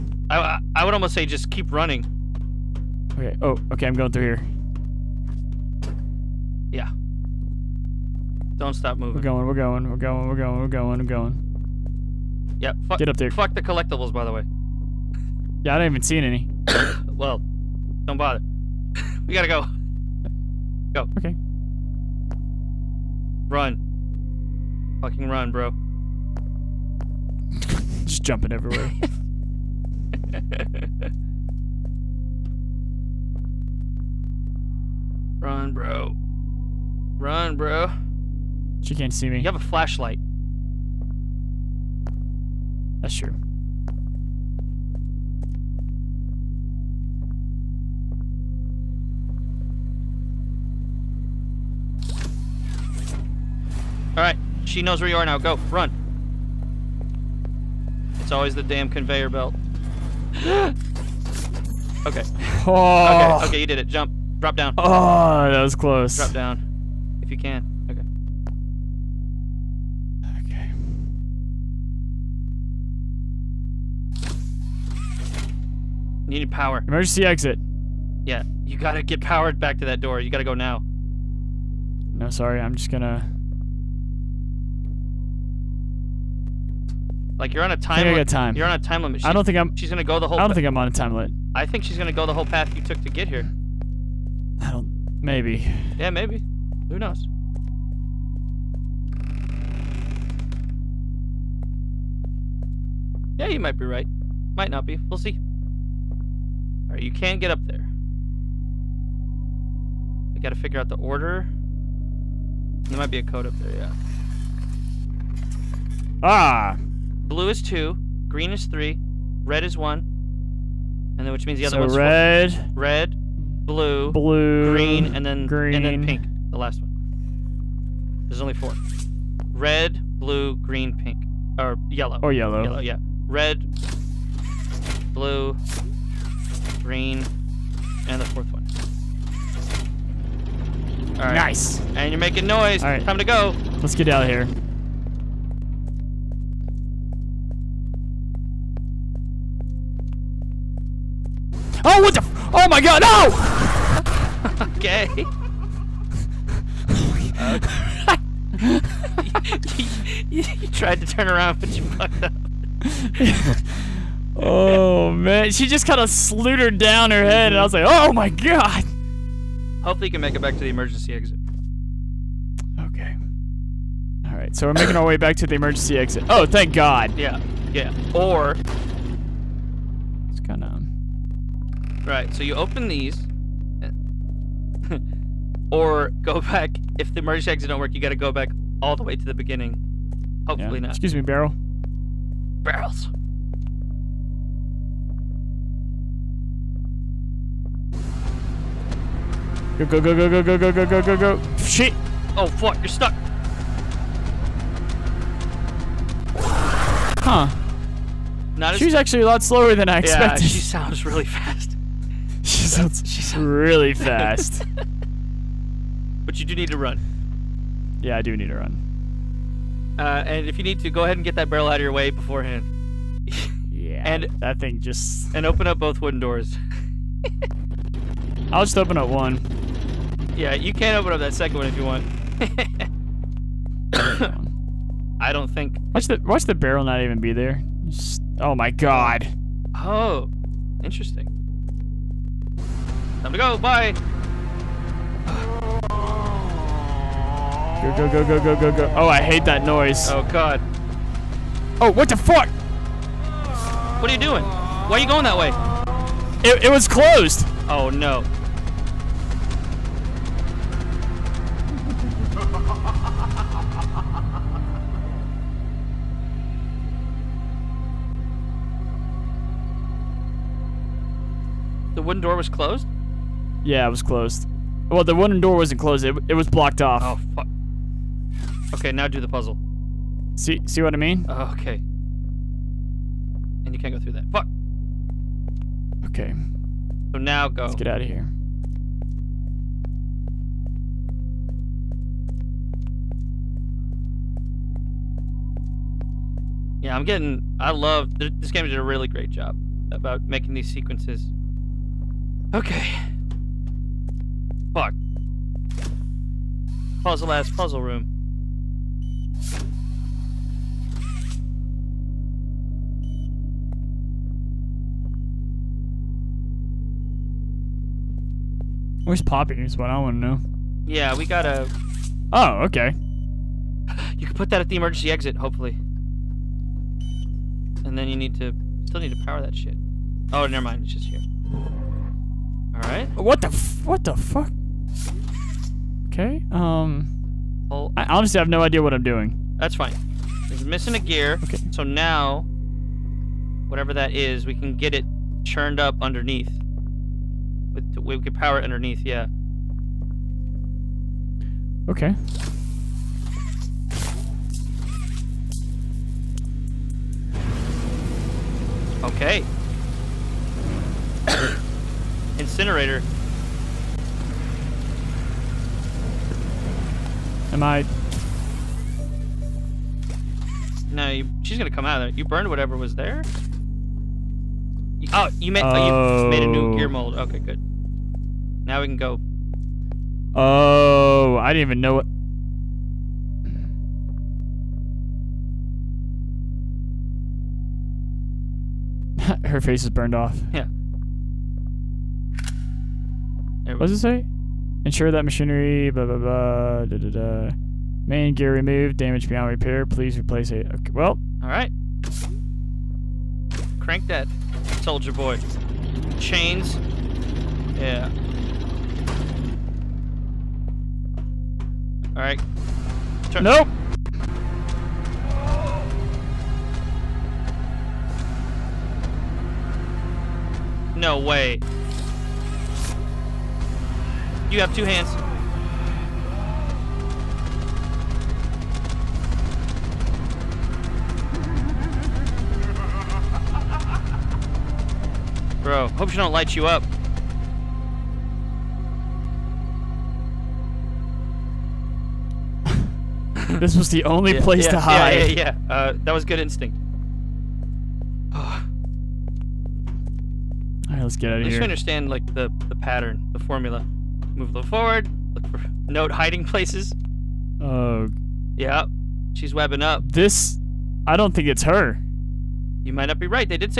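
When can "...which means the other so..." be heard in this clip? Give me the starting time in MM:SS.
02:01.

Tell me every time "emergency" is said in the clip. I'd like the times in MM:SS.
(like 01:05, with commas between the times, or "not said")
01:16, 02:50, 02:55, 03:07, 05:24.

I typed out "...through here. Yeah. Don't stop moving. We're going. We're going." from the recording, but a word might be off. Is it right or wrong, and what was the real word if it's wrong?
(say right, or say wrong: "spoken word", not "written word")
right.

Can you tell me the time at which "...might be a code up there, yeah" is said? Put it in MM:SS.
01:52.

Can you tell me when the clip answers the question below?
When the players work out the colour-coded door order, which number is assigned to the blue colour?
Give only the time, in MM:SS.
01:57.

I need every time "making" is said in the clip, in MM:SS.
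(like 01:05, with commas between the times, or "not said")
02:22, 02:54, 05:00.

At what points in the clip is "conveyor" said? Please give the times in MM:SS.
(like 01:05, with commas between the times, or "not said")
00:58.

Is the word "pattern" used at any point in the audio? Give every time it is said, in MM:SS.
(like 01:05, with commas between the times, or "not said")
07:32.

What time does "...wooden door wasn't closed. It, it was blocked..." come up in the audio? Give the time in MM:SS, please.
04:35.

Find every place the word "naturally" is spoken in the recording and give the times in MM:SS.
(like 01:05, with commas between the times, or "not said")
not said.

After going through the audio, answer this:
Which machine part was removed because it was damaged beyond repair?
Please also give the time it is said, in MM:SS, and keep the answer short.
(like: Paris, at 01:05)
Main gear, at 06:38.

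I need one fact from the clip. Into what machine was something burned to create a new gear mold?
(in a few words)
Incinerator.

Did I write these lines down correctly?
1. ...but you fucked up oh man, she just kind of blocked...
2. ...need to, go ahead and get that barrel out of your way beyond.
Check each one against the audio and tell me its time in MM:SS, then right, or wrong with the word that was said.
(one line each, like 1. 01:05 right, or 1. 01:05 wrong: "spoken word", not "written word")
1. 02:41 wrong: "slutered", not "blocked"
2. 03:40 wrong: "beforehand", not "beyond".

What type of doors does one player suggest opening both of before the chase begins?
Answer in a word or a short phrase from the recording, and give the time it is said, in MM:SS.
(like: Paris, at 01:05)
Wooden doors, at 03:46.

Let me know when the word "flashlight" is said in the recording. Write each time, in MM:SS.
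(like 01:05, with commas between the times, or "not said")
00:39.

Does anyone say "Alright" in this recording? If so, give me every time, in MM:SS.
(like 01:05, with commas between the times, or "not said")
00:54, 01:46, 05:32.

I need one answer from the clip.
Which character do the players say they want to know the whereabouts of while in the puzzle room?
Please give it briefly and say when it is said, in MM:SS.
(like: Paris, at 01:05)
Poppy, at 05:19.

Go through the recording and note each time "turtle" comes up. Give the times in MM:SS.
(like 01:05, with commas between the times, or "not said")
not said.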